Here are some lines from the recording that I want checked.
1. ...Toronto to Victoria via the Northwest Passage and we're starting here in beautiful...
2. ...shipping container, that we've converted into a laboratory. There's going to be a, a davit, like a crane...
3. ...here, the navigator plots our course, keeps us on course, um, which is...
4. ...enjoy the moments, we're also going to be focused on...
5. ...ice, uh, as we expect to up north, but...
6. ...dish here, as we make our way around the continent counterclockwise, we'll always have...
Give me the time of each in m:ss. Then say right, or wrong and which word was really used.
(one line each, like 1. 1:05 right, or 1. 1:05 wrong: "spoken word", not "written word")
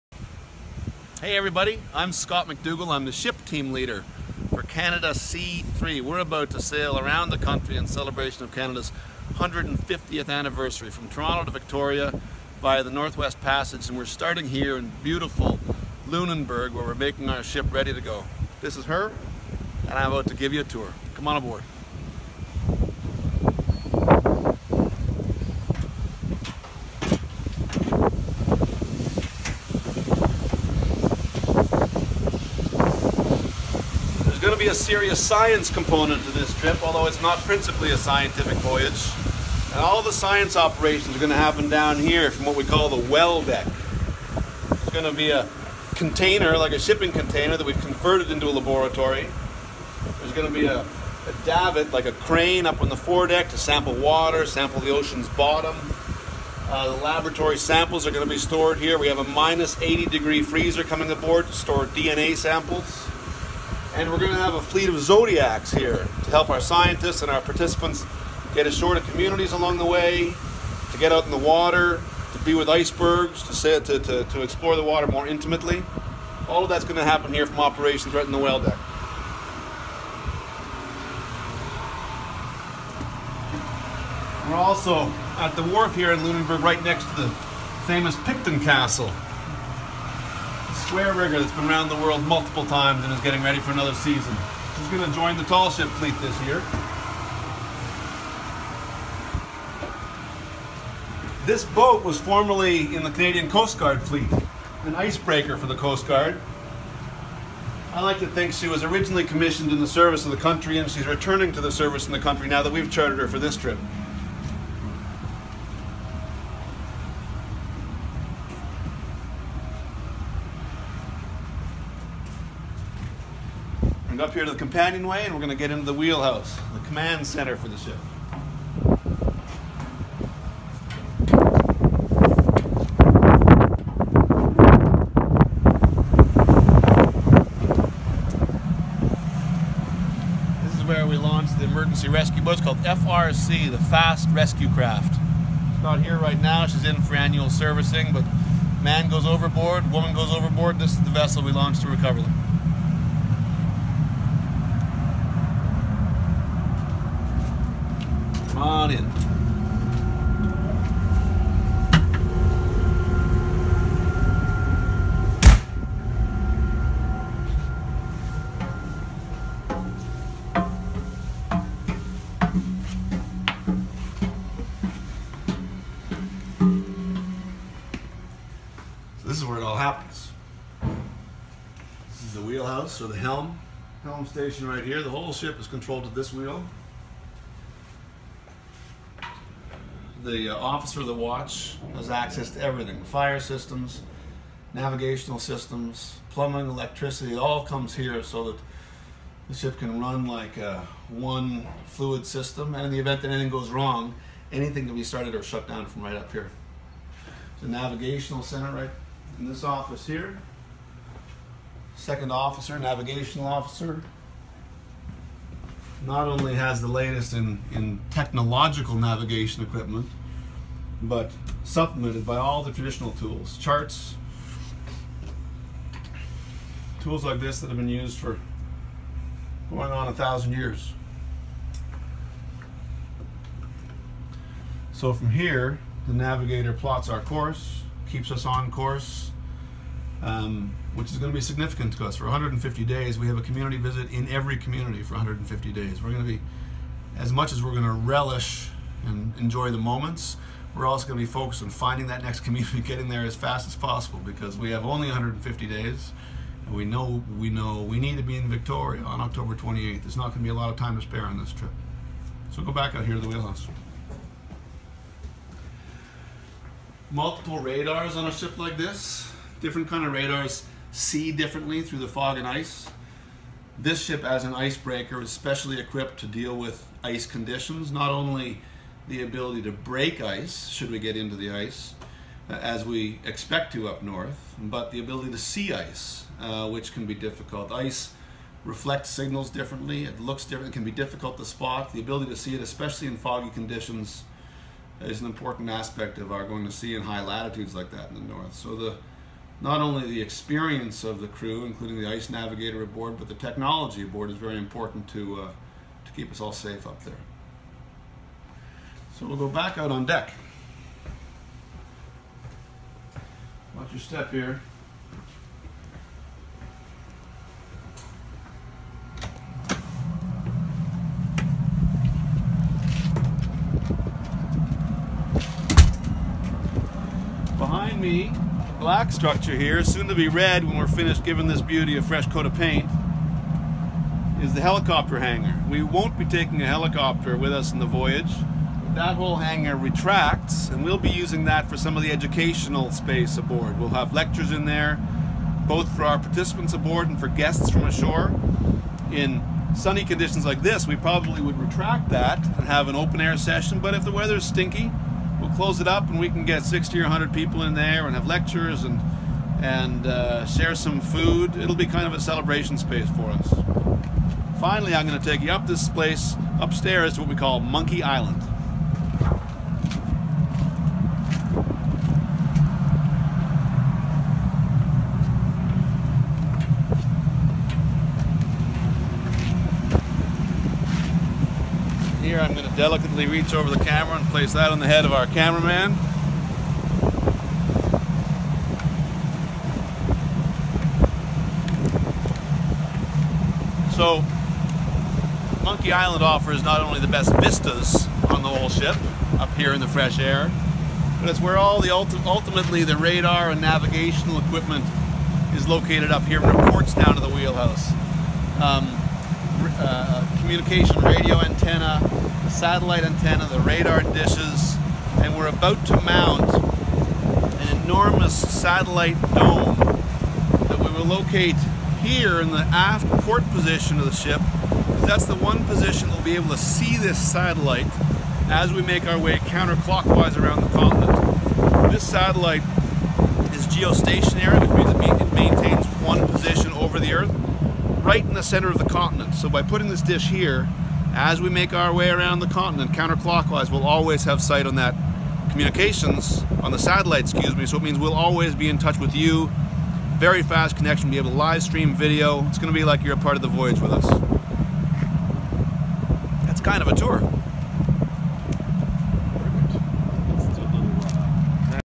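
1. 0:11 right
2. 0:46 right
3. 3:55 right
4. 4:09 right
5. 4:41 right
6. 7:20 right.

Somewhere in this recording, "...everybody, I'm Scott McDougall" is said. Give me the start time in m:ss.
0:01.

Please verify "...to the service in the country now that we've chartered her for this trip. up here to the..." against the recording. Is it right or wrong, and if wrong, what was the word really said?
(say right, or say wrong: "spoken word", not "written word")
right.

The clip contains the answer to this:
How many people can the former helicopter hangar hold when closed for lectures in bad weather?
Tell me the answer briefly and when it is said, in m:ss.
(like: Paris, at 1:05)
60 or 100, at 5:56.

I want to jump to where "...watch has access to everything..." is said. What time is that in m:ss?
3:11.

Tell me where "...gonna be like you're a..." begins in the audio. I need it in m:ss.
7:32.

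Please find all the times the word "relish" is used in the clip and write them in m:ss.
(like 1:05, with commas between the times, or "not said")
4:07.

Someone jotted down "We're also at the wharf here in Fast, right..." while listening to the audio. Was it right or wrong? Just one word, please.
wrong.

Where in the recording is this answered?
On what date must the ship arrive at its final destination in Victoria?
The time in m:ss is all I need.
4:19.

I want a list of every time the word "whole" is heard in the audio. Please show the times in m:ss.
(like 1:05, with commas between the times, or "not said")
3:05, 5:39, 6:38.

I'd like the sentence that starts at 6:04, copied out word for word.
Finally, I'm going to take you up this place upstairs to what we call Monkey Island.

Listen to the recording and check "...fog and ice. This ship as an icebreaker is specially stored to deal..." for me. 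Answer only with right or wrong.
wrong.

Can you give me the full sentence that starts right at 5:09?
So we'll go back out on deck.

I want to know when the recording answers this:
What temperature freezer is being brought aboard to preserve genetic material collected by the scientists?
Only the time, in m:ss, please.
0:59.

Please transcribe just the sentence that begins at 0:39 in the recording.
And all the science operations are going to happen down here from what we call the well deck.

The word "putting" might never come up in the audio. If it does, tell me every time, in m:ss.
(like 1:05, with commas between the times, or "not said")
7:19.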